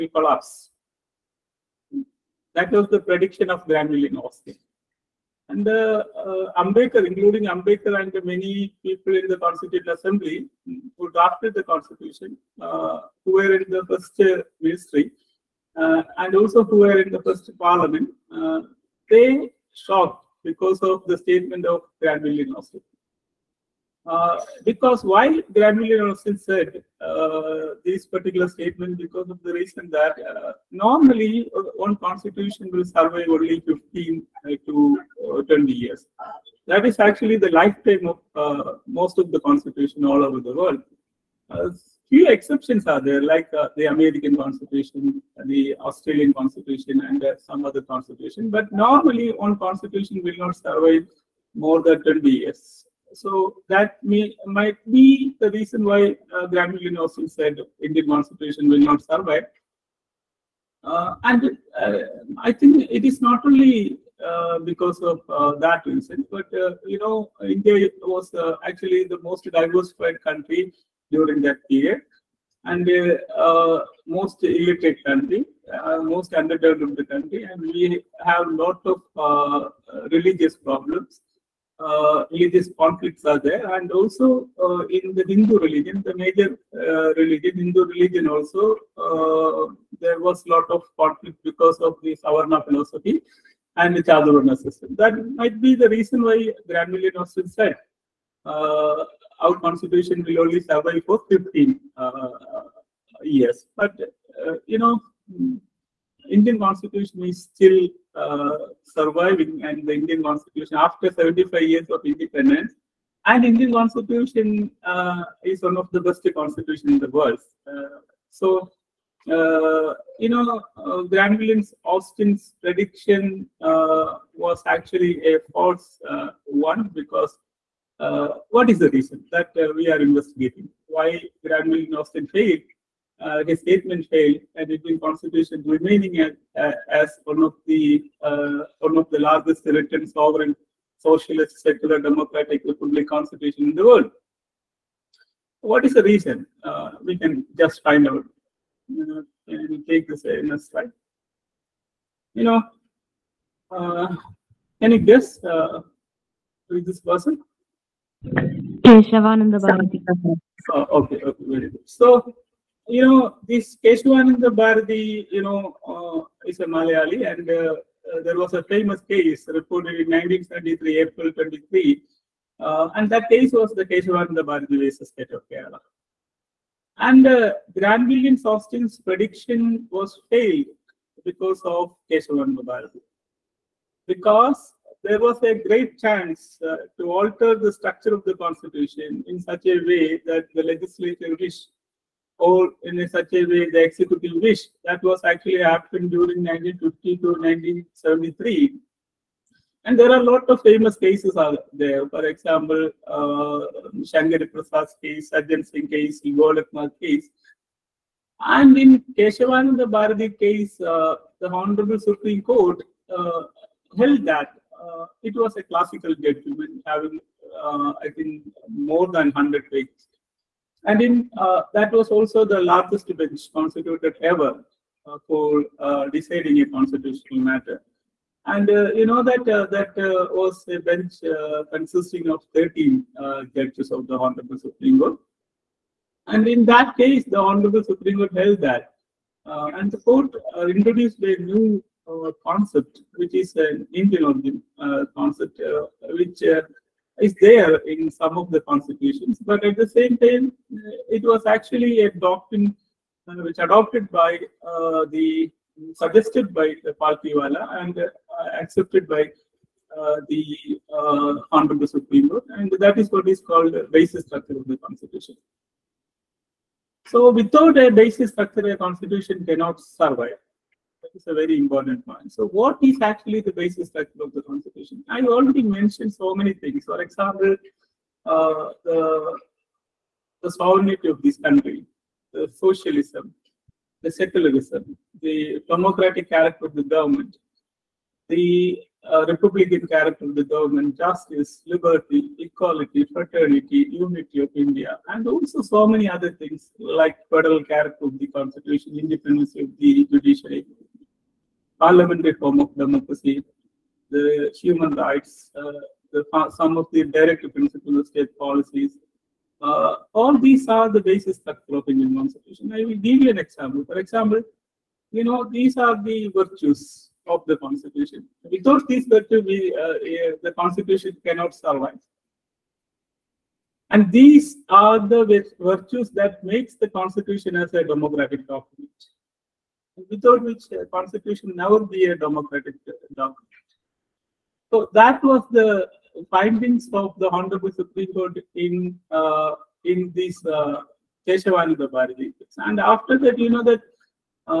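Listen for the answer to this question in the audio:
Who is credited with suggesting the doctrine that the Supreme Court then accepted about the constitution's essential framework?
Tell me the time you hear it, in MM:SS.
04:16.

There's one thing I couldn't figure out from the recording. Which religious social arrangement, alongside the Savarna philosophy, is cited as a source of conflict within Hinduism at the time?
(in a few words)
Chaturvarna system.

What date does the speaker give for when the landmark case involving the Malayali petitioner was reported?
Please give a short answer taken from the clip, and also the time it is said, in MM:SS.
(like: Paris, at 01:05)
April 23, 1923, at 02:50.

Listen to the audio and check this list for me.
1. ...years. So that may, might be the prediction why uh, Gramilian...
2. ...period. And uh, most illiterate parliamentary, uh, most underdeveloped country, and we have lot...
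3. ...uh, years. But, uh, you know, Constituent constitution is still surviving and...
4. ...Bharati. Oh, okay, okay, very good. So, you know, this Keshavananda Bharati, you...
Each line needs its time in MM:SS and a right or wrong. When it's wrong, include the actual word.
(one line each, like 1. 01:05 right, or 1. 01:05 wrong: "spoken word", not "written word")
1. 00:52 wrong: "reason", not "prediction"
2. 01:11 wrong: "country", not "parliamentary"
3. 01:42 wrong: "Indian", not "Constituent"
4. 02:39 right.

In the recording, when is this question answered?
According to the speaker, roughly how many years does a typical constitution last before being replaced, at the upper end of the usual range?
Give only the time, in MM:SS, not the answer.
00:33.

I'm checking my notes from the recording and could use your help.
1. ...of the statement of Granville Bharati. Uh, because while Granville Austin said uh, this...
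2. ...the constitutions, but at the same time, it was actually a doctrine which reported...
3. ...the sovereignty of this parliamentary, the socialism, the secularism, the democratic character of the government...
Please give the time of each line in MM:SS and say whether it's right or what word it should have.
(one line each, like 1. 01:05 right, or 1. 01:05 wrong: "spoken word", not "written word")
1. 00:20 wrong: "Austin", not "Bharati"
2. 04:08 wrong: "adopted", not "reported"
3. 04:40 wrong: "country", not "parliamentary".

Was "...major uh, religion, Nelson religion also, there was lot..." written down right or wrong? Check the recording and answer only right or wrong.
wrong.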